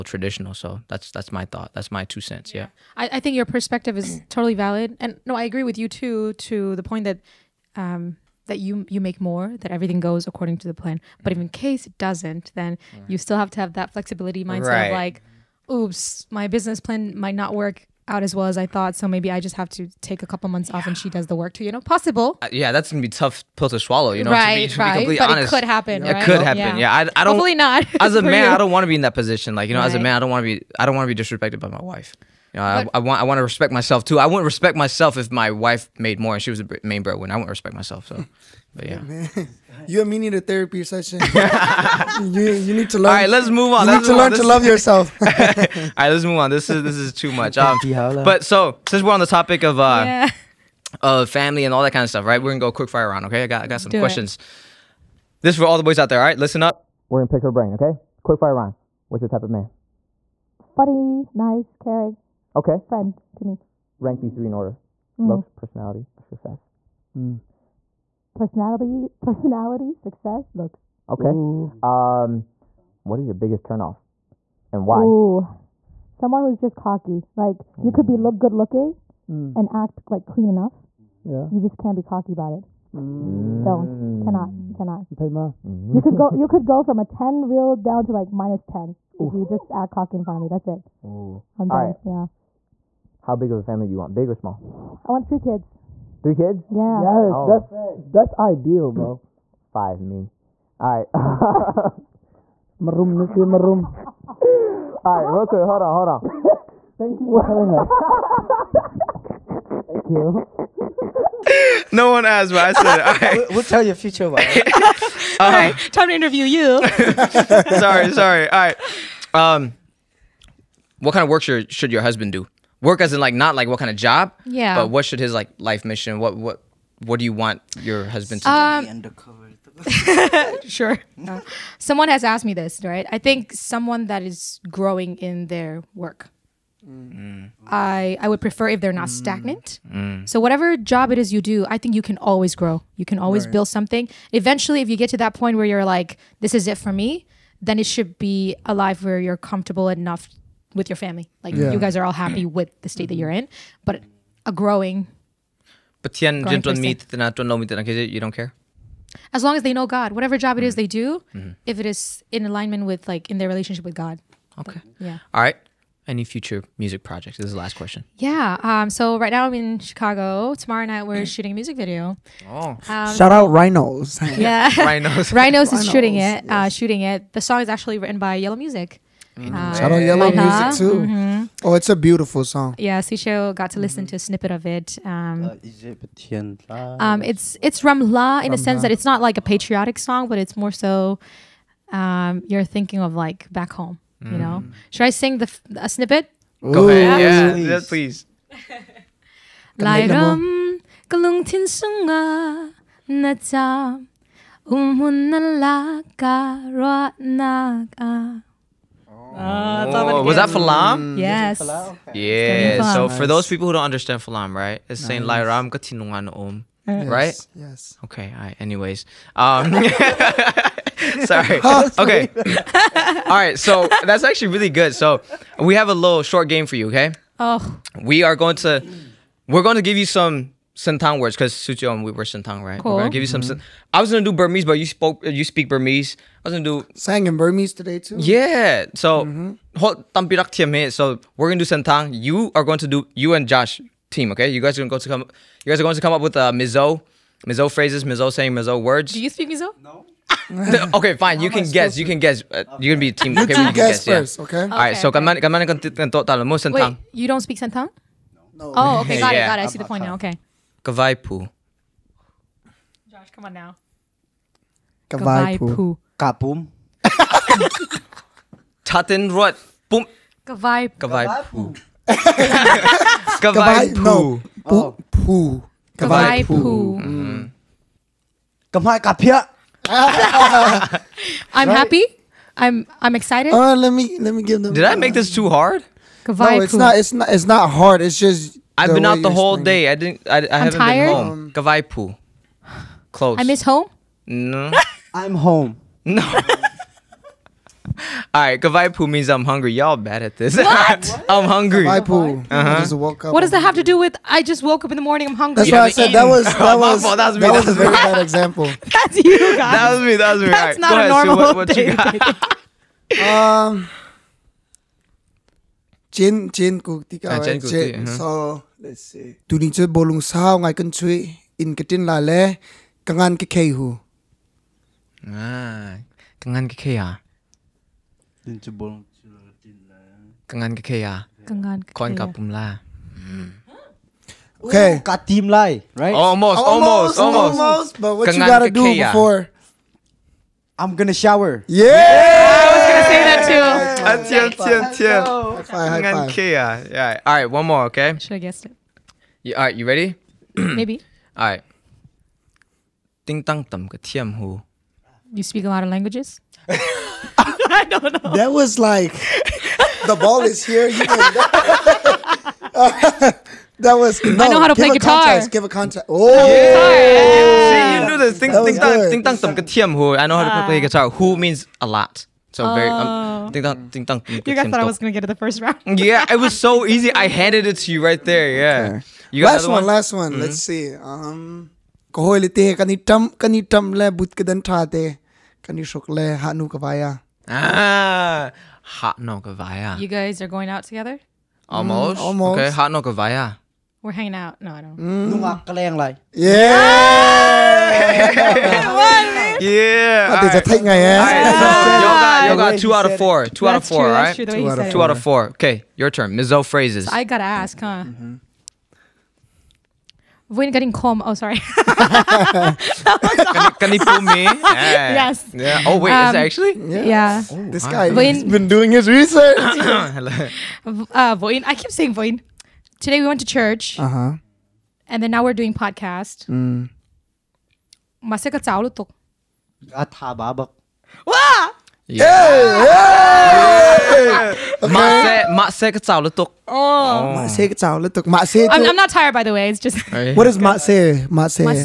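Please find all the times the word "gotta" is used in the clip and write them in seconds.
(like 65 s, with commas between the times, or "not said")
338 s, 407 s.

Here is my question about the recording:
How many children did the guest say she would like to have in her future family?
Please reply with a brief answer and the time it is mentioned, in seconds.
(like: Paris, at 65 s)
3, at 95 s.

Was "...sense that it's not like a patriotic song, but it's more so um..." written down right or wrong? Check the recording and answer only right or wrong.
right.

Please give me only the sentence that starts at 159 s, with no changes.
As long as they know God, whatever job it is mm-hmm.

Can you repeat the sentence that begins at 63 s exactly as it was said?
Rank these three in order: mm.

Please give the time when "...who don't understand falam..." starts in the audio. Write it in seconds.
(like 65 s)
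213 s.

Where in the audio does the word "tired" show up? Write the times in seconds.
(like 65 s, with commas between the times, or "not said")
290 s, 439 s.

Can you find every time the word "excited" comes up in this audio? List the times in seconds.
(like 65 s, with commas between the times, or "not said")
283 s.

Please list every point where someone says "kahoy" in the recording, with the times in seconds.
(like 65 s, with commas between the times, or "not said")
382 s.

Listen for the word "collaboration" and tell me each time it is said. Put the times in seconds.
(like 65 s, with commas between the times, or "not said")
not said.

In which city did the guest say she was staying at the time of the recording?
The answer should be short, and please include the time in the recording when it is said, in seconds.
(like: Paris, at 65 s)
Chicago, at 169 s.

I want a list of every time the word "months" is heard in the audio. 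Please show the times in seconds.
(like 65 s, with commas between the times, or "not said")
20 s.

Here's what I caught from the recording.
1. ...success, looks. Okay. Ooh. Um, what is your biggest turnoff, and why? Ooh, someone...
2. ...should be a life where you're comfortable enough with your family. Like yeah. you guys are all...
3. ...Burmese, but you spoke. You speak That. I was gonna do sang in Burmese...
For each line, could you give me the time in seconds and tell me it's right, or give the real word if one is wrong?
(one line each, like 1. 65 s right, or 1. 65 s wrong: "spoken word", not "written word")
1. 69 s right
2. 147 s right
3. 234 s wrong: "Burmese", not "That".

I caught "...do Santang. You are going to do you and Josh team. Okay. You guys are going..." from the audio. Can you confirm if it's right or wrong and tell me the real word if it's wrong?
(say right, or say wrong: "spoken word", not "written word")
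right.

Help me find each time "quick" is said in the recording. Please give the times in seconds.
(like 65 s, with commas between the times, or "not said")
52 s, 58 s, 105 s.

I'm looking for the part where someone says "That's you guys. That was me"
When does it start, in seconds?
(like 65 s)
308 s.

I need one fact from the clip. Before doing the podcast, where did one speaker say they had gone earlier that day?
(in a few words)
Church.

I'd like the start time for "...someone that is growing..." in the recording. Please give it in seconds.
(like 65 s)
133 s.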